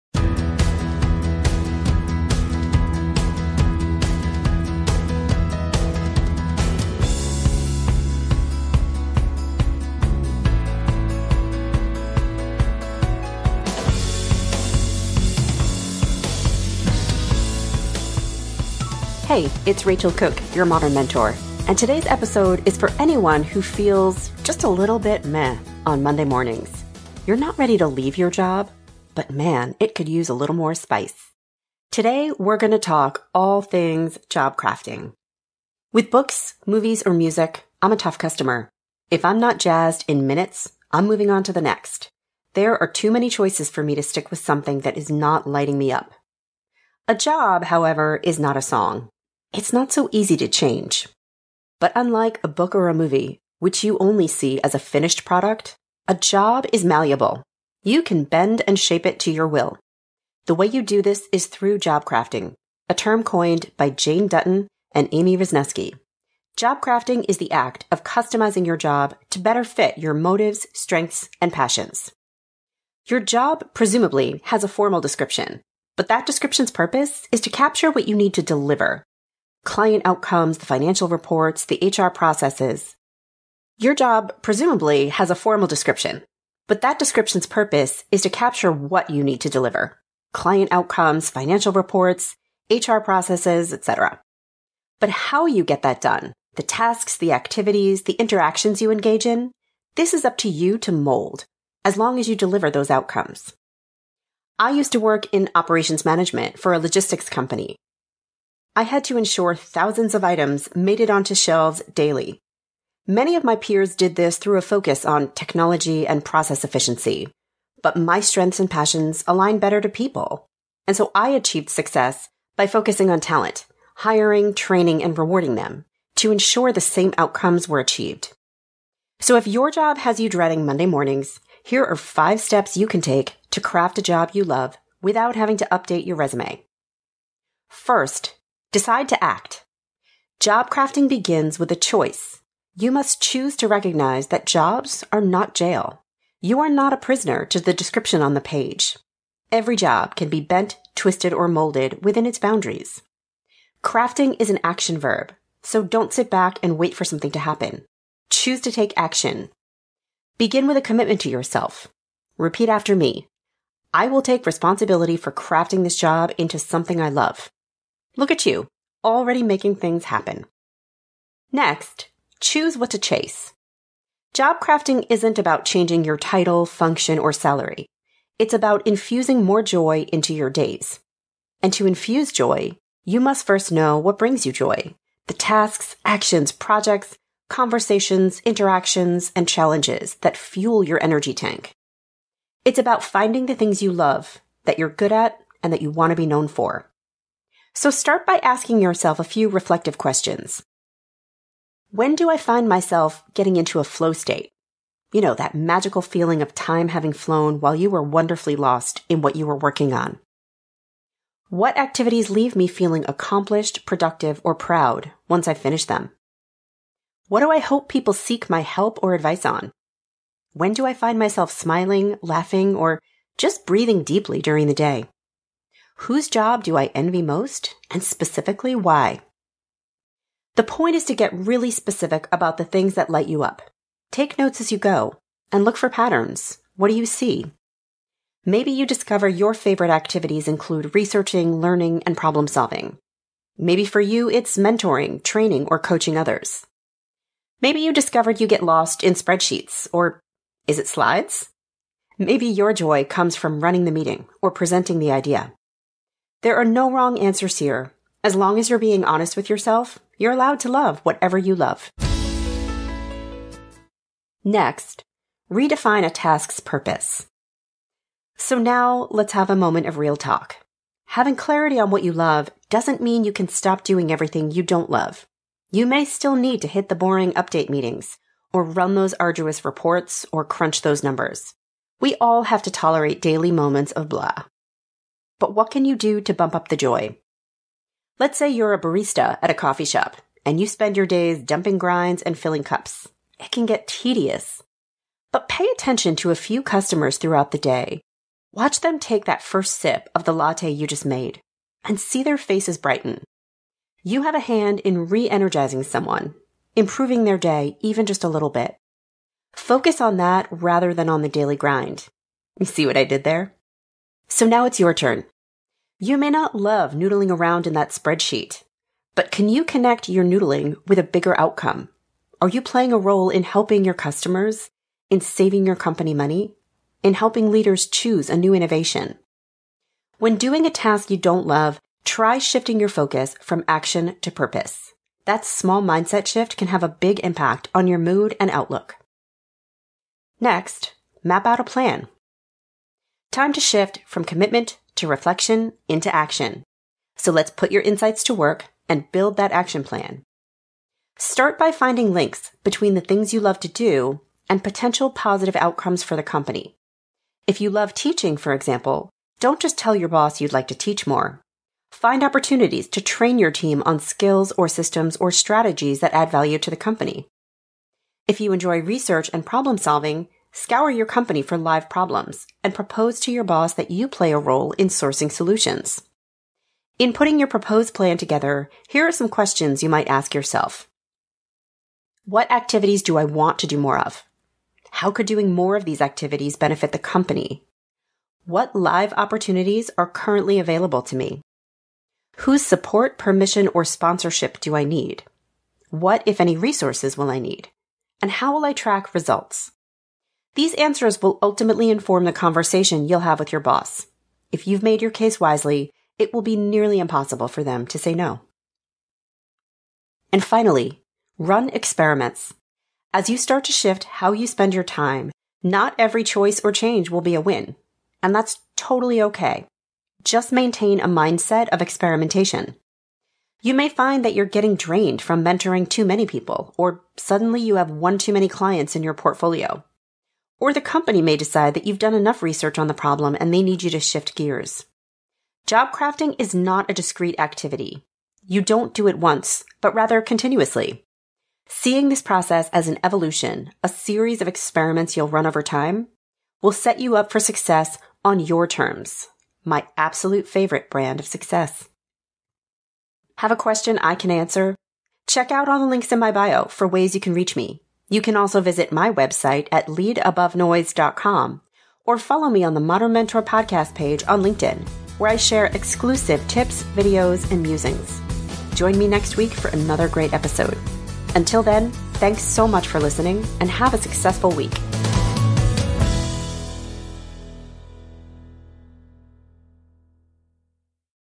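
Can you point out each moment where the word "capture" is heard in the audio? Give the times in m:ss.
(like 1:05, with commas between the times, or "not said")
1:17, 1:28.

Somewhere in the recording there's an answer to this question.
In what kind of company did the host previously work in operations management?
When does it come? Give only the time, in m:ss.
1:46.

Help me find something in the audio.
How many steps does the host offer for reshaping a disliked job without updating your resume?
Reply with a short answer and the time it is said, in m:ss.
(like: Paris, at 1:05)
5, at 2:11.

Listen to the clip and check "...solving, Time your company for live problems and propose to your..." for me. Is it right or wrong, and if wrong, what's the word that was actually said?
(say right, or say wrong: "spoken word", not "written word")
wrong: "Scour", not "Time".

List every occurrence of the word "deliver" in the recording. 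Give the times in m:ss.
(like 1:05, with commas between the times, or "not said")
1:18, 1:29, 1:42.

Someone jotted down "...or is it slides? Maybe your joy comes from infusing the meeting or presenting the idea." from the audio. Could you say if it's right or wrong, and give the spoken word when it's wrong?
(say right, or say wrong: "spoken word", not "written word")
wrong: "running", not "infusing".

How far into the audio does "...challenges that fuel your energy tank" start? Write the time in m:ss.
3:09.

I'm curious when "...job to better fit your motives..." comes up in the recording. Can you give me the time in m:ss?
1:08.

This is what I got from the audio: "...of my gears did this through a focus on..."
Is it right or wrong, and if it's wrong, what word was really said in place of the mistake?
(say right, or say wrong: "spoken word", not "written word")
wrong: "peers", not "gears".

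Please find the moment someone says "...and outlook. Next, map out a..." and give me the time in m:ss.
5:38.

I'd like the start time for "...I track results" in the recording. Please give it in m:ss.
6:38.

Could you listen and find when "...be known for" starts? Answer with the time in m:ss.
3:16.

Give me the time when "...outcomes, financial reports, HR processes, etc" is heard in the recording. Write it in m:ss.
1:30.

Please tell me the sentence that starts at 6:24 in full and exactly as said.
How could doing more of these activities benefit the company?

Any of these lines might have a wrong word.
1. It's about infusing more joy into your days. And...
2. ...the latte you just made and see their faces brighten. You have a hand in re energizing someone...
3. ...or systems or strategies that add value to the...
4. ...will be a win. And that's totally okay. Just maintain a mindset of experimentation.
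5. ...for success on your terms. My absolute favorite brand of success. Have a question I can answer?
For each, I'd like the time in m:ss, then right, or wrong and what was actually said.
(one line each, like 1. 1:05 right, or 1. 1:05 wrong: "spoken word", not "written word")
1. 2:58 right
2. 5:00 right
3. 6:04 right
4. 6:57 right
5. 7:27 right.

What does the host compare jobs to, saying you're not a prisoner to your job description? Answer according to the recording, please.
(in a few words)
Jail.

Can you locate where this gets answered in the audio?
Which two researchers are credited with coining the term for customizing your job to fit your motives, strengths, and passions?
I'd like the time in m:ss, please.
1:03.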